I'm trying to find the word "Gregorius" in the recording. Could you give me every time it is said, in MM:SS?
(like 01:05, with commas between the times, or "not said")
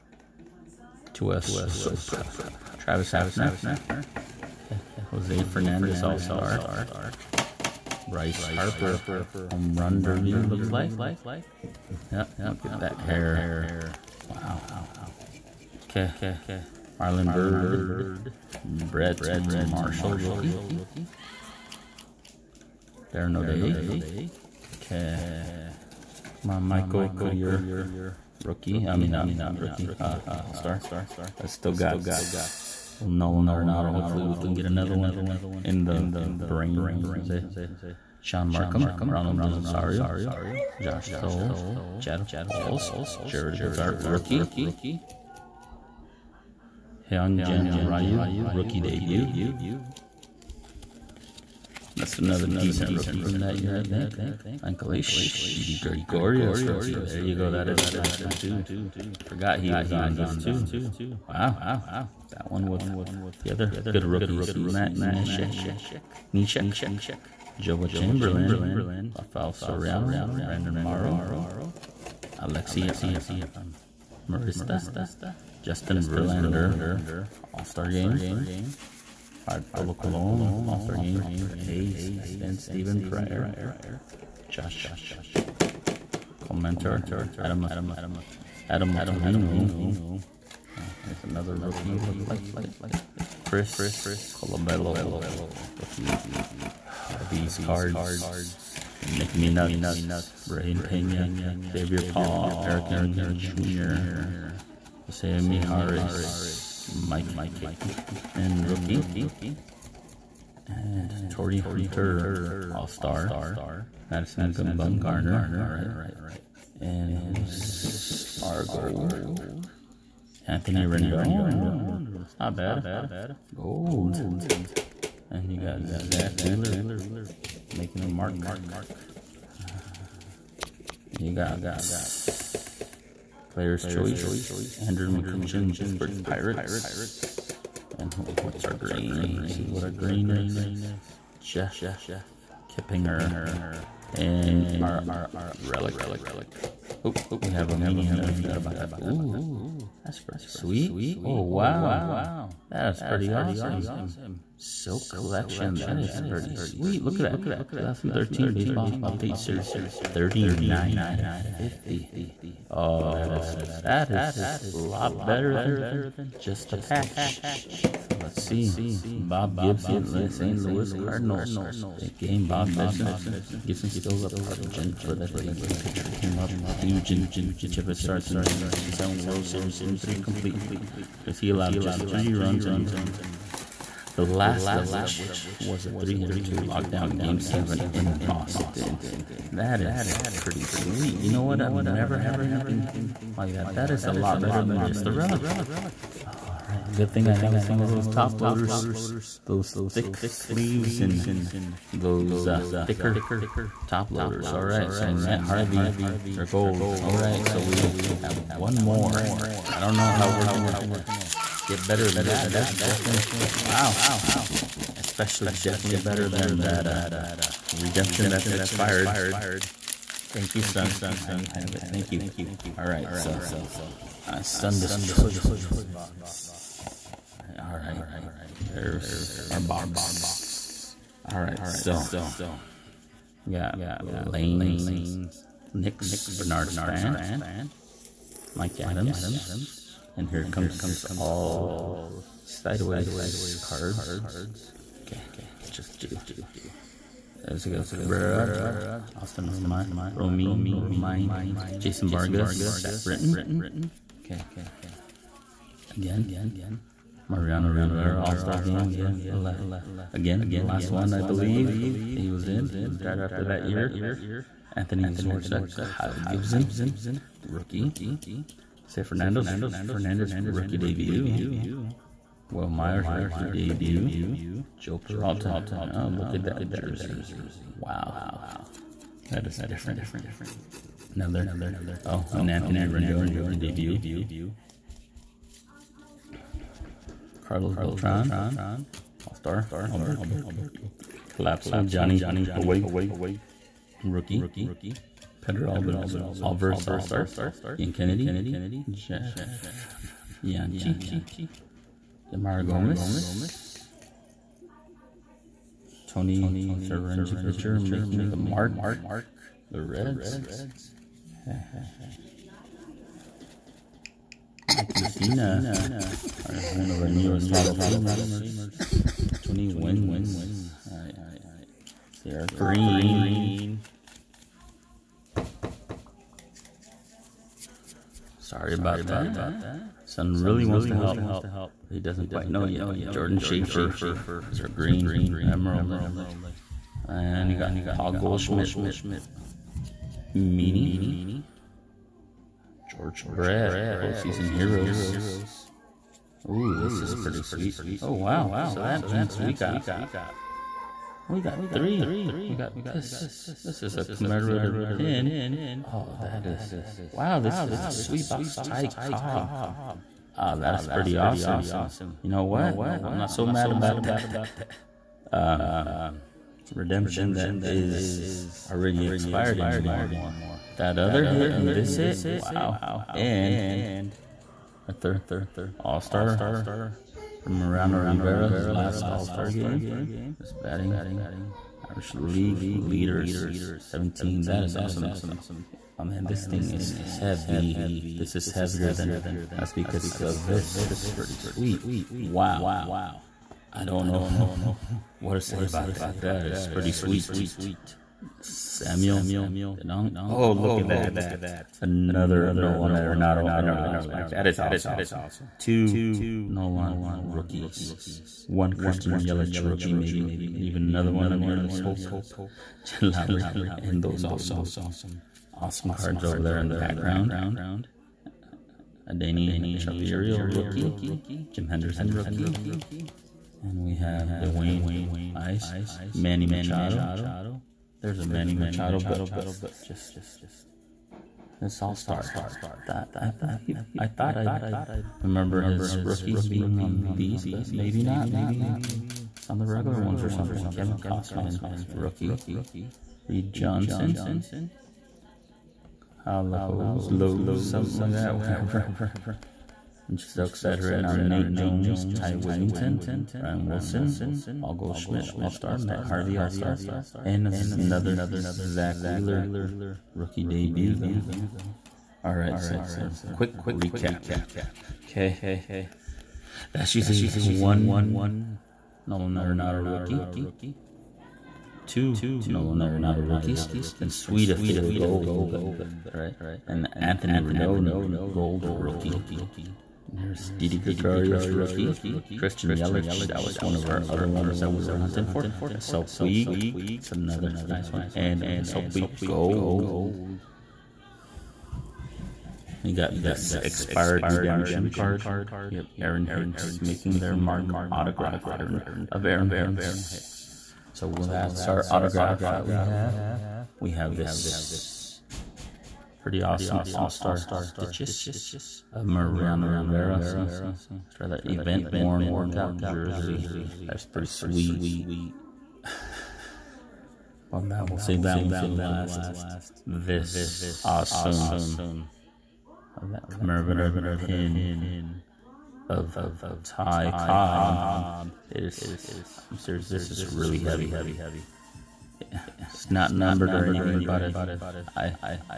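00:55, 08:00.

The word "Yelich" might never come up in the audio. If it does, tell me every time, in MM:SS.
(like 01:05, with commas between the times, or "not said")
06:49, 08:02.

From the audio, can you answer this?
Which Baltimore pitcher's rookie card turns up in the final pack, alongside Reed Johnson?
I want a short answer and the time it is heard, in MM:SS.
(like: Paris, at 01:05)
Kevin Gausman, at 07:20.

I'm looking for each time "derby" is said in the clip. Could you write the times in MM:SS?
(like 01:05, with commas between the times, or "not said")
00:10.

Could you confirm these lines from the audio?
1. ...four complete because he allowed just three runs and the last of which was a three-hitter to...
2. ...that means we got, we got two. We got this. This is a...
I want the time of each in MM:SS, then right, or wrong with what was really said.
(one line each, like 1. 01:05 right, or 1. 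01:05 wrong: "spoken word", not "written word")
1. 02:59 wrong: "three", not "four"
2. 05:48 wrong: "three", not "two".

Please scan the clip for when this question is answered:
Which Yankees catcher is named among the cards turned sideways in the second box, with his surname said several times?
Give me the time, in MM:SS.
04:09.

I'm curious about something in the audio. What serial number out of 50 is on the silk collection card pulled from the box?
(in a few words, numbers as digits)
39.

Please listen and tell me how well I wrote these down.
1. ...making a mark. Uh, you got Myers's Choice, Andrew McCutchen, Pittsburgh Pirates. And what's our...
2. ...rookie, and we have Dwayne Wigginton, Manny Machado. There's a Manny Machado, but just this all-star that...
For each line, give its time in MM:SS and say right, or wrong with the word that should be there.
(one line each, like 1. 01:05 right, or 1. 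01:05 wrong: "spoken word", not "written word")
1. 02:07 wrong: "Player", not "Myers"
2. 07:02 wrong: "Ice", not "Wigginton".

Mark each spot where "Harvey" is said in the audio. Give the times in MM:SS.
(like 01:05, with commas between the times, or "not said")
03:25, 07:36.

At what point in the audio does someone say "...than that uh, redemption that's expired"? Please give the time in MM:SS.
03:36.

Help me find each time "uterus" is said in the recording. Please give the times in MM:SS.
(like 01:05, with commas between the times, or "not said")
not said.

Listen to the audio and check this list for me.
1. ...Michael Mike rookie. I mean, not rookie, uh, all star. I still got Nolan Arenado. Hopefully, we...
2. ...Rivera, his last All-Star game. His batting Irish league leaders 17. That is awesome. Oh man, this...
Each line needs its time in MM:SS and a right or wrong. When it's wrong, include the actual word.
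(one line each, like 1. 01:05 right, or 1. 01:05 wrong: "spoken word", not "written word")
1. 00:26 wrong: "Clear", not "Mike"
2. 06:18 right.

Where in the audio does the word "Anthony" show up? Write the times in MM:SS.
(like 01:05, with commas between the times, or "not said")
02:00, 04:24, 04:42, 07:56.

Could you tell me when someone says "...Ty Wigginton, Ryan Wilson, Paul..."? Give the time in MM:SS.
07:32.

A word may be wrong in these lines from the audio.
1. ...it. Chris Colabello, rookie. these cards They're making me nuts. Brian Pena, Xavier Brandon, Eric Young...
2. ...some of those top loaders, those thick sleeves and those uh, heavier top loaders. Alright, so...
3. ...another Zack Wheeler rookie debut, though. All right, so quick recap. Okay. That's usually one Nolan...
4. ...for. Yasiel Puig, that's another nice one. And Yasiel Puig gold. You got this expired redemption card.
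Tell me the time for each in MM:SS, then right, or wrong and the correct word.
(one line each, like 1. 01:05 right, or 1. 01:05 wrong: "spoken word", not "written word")
1. 01:32 wrong: "Paul", not "Brandon"
2. 03:17 wrong: "thicker", not "heavier"
3. 07:37 right
4. 08:05 right.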